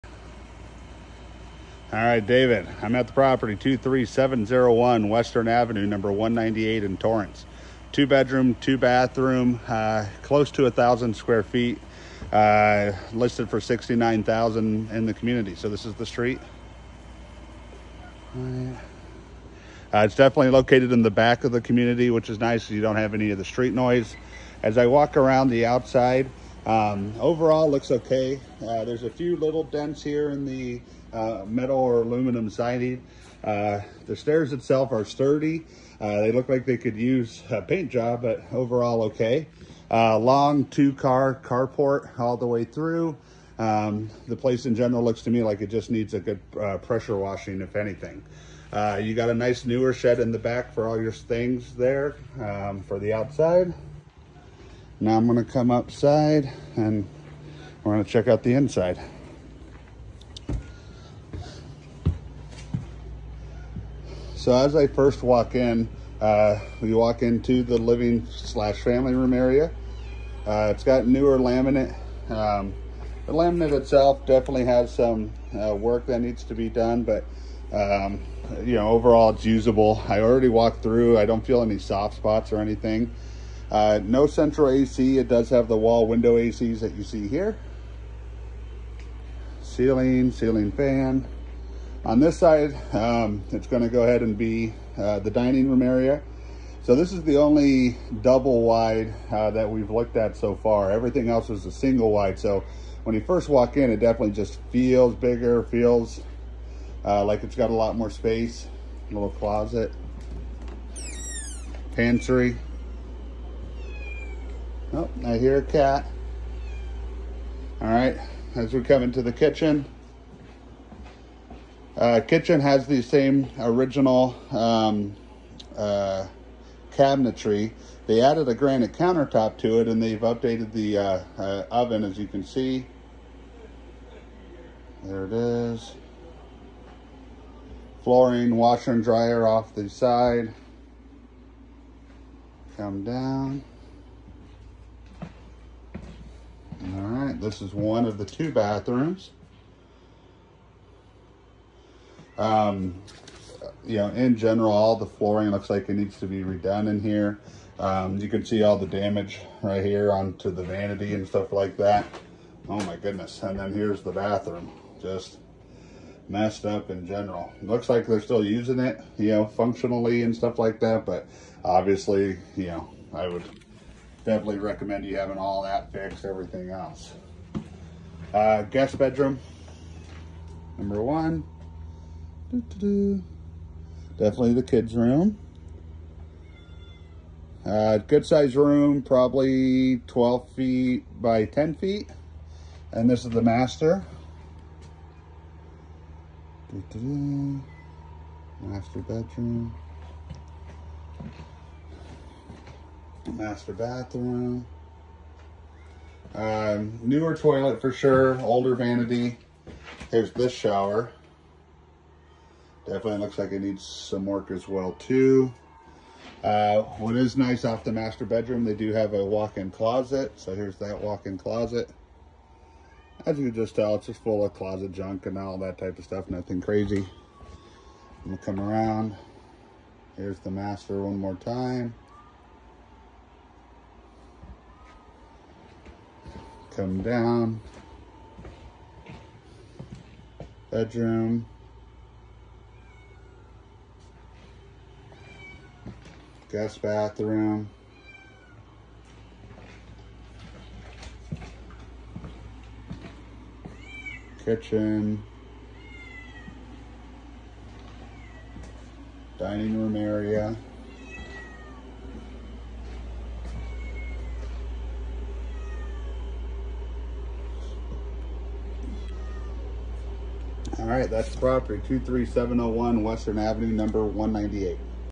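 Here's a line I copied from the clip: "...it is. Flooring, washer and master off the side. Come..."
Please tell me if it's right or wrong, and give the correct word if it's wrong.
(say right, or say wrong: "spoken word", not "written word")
wrong: "dryer", not "master".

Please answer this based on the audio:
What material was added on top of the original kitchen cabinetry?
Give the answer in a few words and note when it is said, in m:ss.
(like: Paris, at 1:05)
granite countertop, at 2:08.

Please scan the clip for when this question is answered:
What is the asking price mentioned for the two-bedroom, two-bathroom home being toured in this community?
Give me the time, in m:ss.
0:13.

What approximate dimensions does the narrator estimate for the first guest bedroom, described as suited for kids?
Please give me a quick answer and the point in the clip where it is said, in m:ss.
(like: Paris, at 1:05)
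12 feet by 10 feet, at 3:10.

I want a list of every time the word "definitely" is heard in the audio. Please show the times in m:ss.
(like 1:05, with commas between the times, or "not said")
0:20, 1:14, 1:44, 2:54, 3:04, 3:32.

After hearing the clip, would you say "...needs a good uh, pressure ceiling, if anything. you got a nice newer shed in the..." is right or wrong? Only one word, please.
wrong.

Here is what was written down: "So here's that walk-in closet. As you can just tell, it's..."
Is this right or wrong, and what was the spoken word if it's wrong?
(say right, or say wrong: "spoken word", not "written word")
right.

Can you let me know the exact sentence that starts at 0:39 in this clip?
Uh, long two-car carport all the way through.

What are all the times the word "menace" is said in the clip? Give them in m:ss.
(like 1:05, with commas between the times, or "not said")
not said.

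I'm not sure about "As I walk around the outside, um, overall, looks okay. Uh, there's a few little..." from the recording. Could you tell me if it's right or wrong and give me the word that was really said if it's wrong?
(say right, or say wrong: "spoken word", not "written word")
right.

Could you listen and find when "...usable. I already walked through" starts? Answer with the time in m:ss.
1:19.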